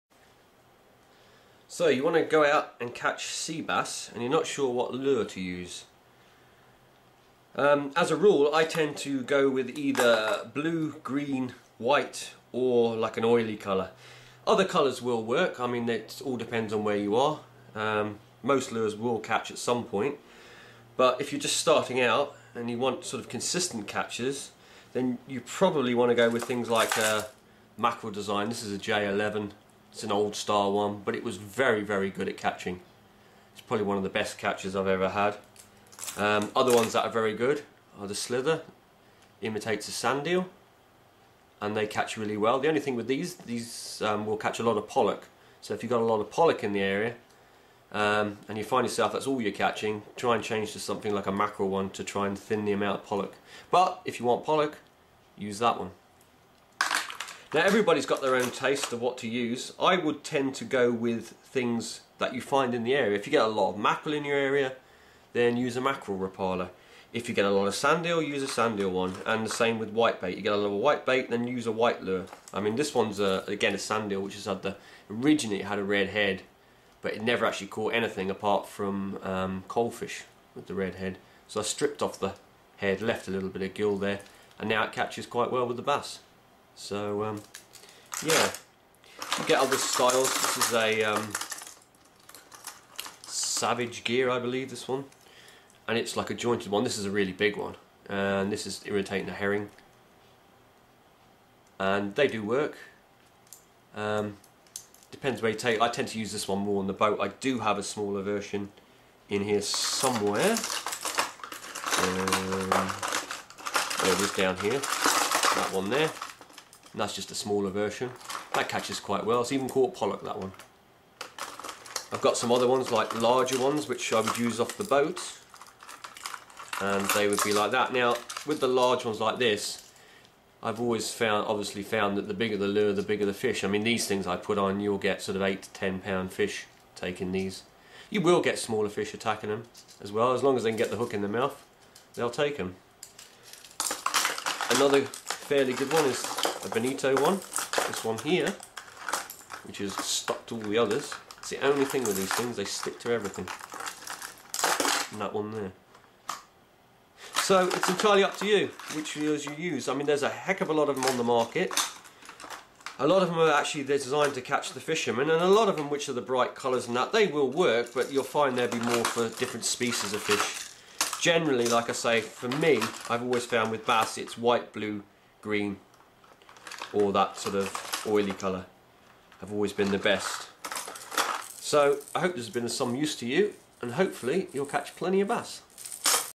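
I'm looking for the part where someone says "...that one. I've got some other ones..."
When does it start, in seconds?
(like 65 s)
120 s.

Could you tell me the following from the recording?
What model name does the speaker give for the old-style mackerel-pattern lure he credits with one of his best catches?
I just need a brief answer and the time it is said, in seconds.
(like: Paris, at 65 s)
J11, at 28 s.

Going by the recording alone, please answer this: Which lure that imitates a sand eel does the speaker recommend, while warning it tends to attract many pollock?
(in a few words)
Slither.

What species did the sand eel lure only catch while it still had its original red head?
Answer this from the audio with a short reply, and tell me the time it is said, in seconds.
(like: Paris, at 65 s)
coalfish, at 79 s.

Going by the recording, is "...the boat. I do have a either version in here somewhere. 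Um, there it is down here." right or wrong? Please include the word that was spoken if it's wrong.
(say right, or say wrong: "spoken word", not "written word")
wrong: "smaller", not "either".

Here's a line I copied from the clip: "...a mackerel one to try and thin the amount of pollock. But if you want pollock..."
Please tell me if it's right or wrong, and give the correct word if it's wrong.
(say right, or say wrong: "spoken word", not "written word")
right.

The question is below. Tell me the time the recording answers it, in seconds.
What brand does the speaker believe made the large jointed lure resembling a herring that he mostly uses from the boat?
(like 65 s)
93 s.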